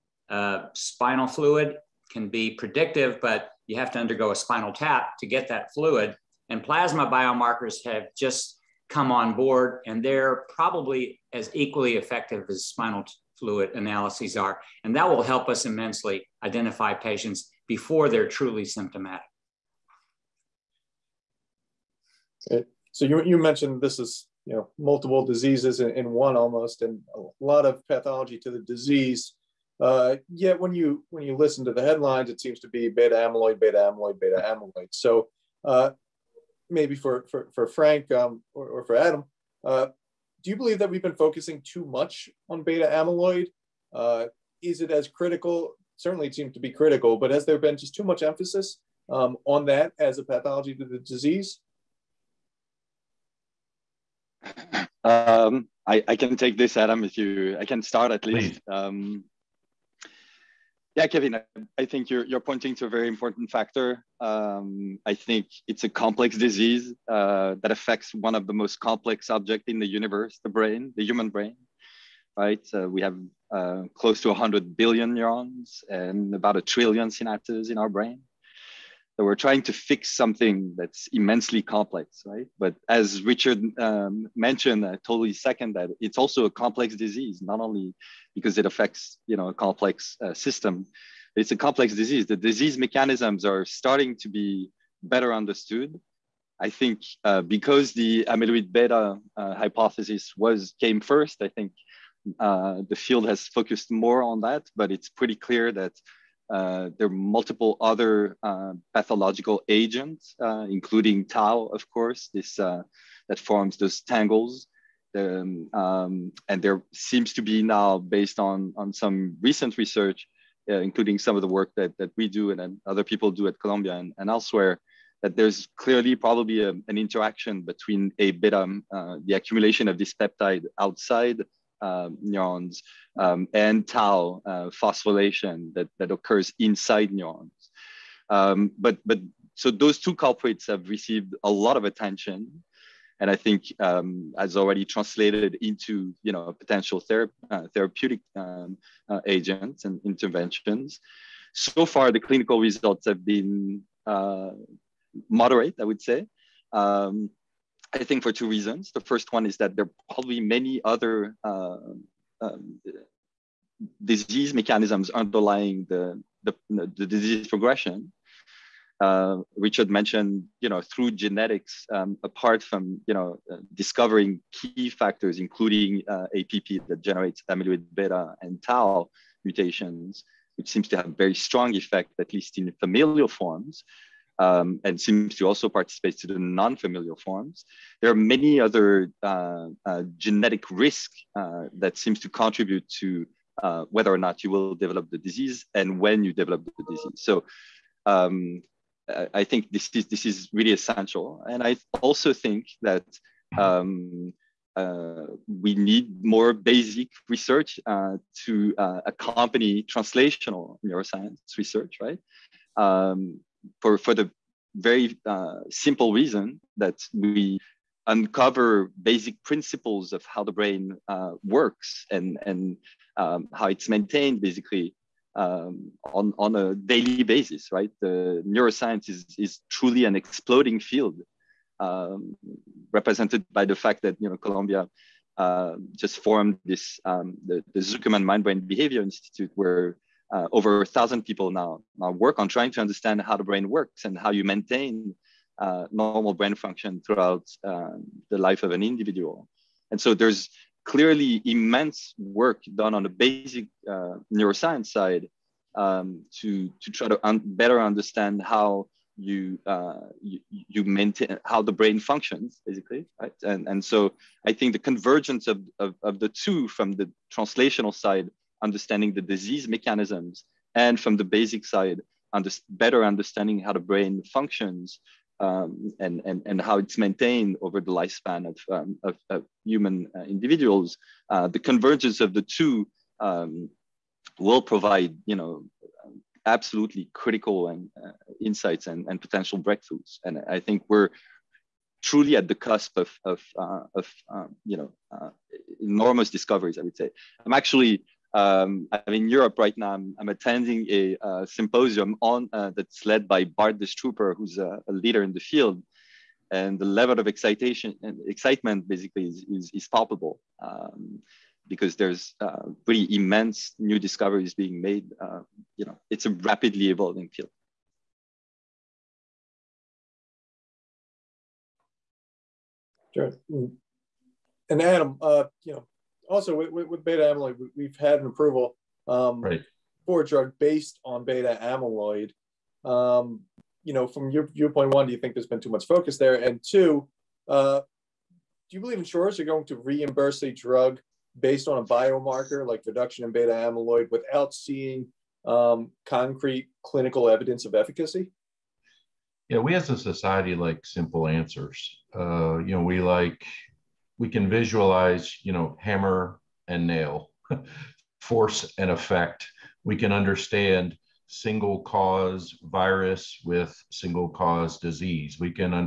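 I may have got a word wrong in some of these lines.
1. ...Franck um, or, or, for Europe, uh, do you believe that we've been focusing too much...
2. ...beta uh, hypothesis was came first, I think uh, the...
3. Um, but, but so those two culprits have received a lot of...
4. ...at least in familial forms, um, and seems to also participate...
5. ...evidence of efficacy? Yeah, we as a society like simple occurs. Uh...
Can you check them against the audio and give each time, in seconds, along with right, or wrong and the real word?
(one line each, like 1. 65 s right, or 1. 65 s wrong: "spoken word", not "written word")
1. 37 s wrong: "Adam", not "Europe"
2. 98 s right
3. 138 s right
4. 182 s right
5. 347 s wrong: "answers", not "occurs".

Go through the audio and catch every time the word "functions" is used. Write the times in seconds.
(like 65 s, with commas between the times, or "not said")
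246 s, 261 s, 274 s.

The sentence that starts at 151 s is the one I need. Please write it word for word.
So far, the clinical results have been uh, moderate, I would say, um, I think for two reasons.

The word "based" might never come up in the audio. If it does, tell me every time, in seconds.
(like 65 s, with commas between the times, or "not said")
117 s, 330 s, 341 s.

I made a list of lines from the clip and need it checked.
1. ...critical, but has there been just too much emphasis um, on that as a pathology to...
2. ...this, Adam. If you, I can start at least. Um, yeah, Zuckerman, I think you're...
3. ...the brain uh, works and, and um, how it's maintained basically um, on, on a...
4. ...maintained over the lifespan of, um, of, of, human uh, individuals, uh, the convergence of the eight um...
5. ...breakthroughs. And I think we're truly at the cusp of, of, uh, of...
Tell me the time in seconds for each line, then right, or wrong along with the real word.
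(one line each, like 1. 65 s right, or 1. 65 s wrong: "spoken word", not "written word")
1. 46 s right
2. 56 s wrong: "Kevin", not "Zuckerman"
3. 220 s right
4. 276 s wrong: "two", not "eight"
5. 289 s right.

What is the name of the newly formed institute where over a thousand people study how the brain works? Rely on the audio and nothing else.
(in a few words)
Zuckerman Mind Brain Behavior Institute.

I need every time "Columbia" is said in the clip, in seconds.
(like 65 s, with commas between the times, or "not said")
123 s, 234 s.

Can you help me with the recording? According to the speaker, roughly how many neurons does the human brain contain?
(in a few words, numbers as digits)
100 billion.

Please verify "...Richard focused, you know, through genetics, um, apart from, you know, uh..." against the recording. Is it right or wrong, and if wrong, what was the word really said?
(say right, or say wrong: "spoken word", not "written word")
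wrong: "mentioned", not "focused".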